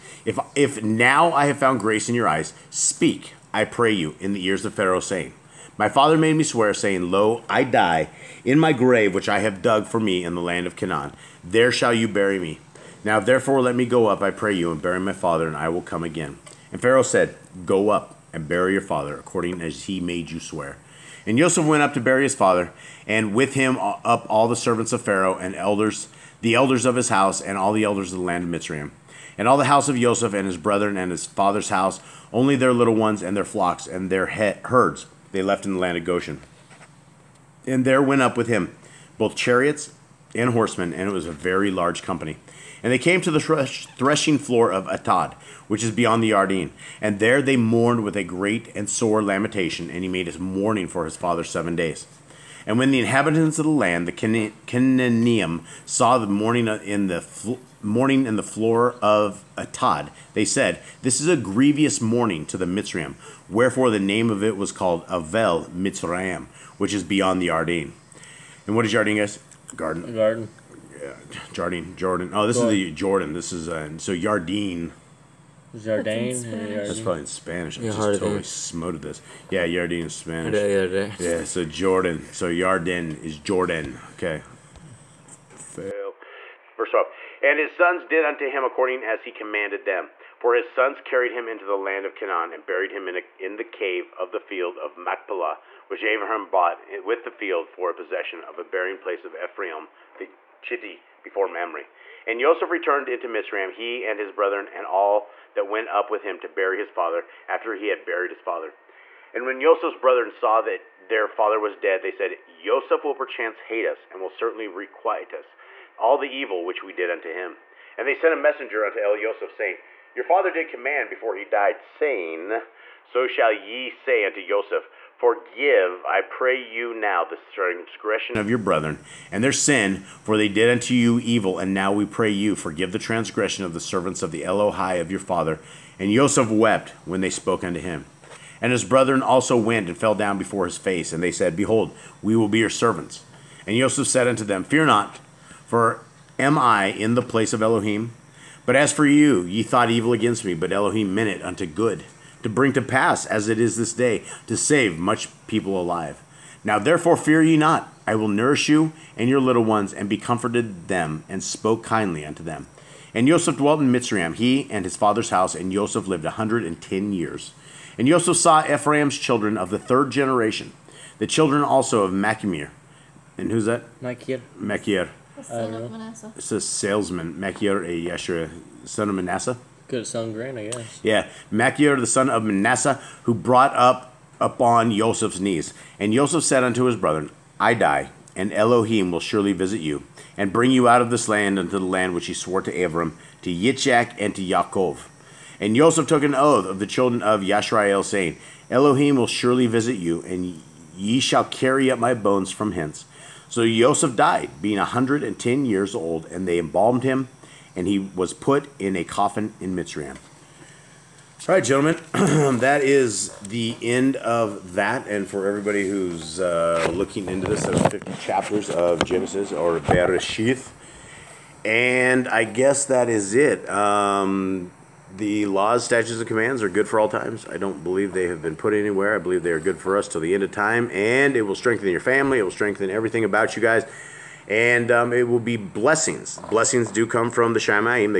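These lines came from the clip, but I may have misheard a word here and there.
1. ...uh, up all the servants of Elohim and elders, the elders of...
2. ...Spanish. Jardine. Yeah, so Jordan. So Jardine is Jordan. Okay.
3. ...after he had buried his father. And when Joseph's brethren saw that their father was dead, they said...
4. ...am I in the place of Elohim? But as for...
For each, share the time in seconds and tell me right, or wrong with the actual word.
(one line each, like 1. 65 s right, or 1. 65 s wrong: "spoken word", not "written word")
1. 23 s wrong: "Pharaoh", not "Elohim"
2. 80 s right
3. 107 s right
4. 146 s right.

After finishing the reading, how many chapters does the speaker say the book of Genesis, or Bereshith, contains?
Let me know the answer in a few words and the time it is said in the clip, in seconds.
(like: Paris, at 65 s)
50, at 217 s.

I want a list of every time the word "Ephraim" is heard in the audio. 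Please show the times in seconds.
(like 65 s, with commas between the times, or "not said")
99 s, 168 s.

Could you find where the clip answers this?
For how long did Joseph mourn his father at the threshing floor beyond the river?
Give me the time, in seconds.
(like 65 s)
51 s.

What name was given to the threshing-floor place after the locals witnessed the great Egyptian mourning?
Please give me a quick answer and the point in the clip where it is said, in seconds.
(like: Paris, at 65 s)
Avel Mitzrayim, at 65 s.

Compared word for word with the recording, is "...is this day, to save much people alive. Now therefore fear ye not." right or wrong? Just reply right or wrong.
right.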